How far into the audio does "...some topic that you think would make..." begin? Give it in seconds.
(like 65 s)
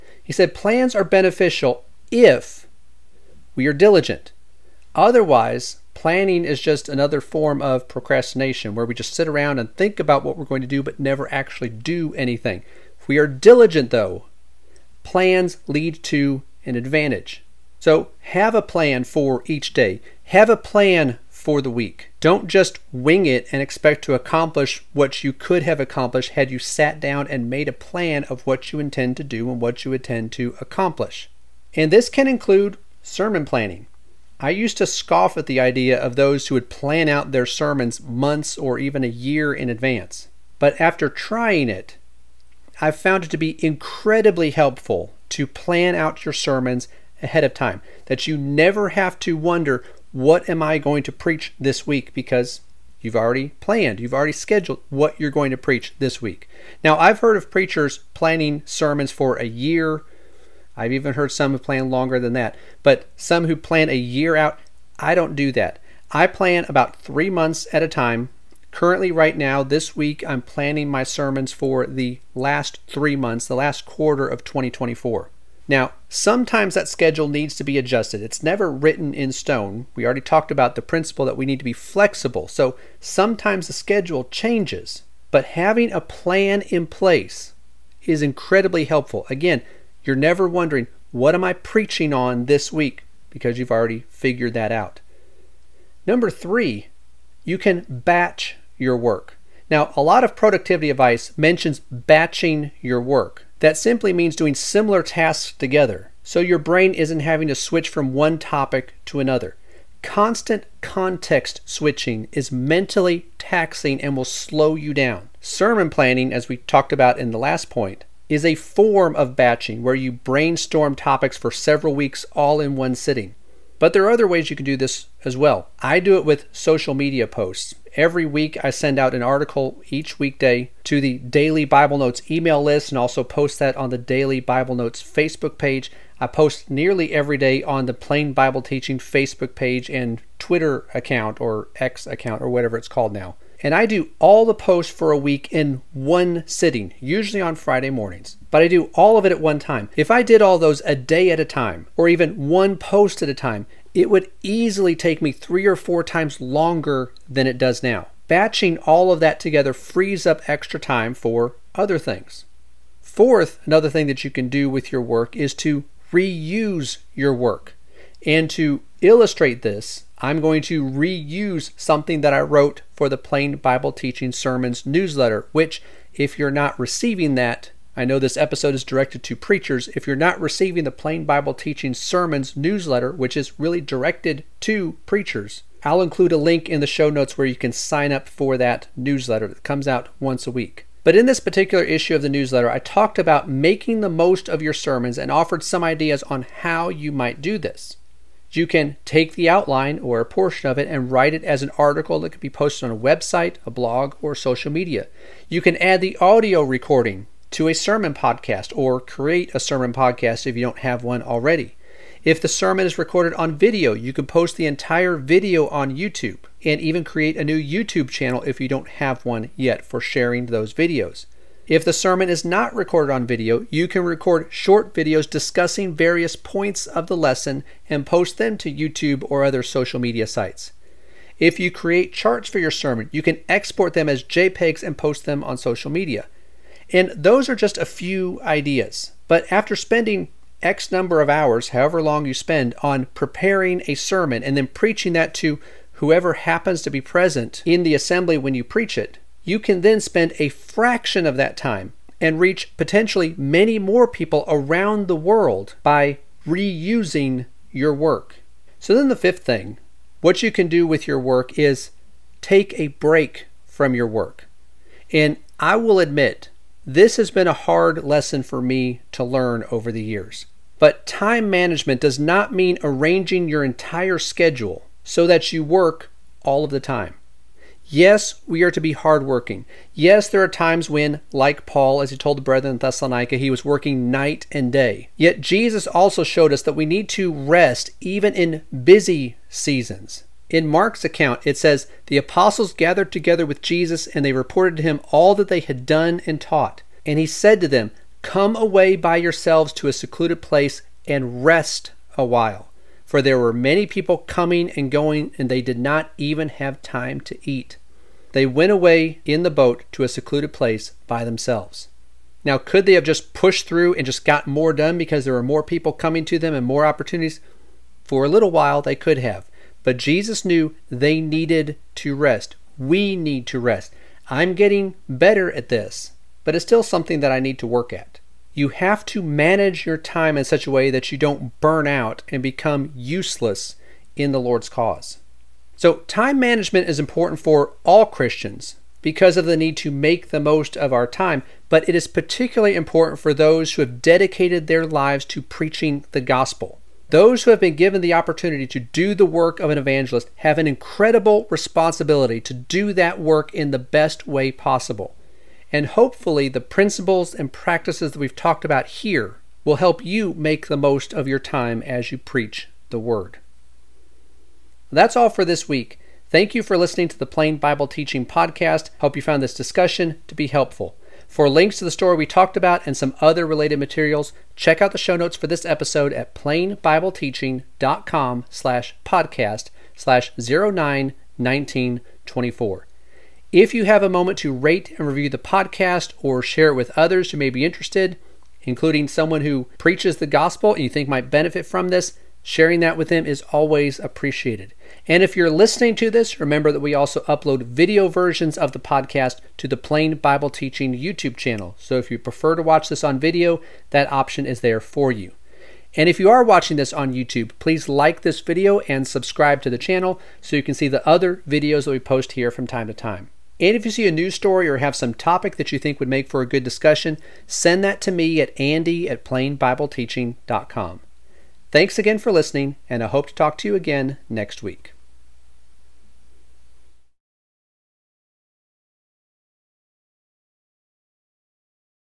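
414 s.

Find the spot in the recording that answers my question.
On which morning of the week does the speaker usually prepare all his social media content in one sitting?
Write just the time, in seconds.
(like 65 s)
147 s.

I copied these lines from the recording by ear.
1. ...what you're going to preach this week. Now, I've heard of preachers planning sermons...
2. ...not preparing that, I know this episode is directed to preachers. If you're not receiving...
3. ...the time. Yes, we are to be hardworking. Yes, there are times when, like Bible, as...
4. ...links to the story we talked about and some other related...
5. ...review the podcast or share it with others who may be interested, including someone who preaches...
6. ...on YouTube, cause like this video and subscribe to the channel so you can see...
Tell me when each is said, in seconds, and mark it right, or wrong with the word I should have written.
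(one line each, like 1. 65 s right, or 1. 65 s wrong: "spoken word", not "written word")
1. 54 s right
2. 176 s wrong: "receiving", not "preparing"
3. 276 s wrong: "Paul", not "Bible"
4. 371 s right
5. 385 s right
6. 406 s wrong: "please", not "cause".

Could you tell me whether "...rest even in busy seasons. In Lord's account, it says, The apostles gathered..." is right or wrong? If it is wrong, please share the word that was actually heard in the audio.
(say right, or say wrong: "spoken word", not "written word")
wrong: "Mark", not "Lord".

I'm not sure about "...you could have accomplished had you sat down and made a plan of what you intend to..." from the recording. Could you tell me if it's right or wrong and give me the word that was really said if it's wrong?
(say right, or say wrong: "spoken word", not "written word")
right.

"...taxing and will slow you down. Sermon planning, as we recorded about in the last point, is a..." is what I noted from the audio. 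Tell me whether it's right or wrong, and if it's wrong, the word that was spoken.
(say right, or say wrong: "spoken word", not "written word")
wrong: "talked", not "recorded".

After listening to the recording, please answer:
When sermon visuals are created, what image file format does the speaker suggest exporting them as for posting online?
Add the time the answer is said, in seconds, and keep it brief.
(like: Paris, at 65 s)
JPEGs, at 234 s.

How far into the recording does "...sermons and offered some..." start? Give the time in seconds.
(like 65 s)
194 s.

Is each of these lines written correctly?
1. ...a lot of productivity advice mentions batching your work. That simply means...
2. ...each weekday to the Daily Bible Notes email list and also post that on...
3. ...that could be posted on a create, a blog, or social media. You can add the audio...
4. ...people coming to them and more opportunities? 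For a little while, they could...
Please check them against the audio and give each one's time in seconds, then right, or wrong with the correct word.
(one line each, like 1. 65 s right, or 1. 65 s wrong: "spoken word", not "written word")
1. 99 s right
2. 129 s right
3. 202 s wrong: "website", not "create"
4. 315 s right.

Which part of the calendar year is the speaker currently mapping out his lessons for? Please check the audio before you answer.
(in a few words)
last quarter of 2024.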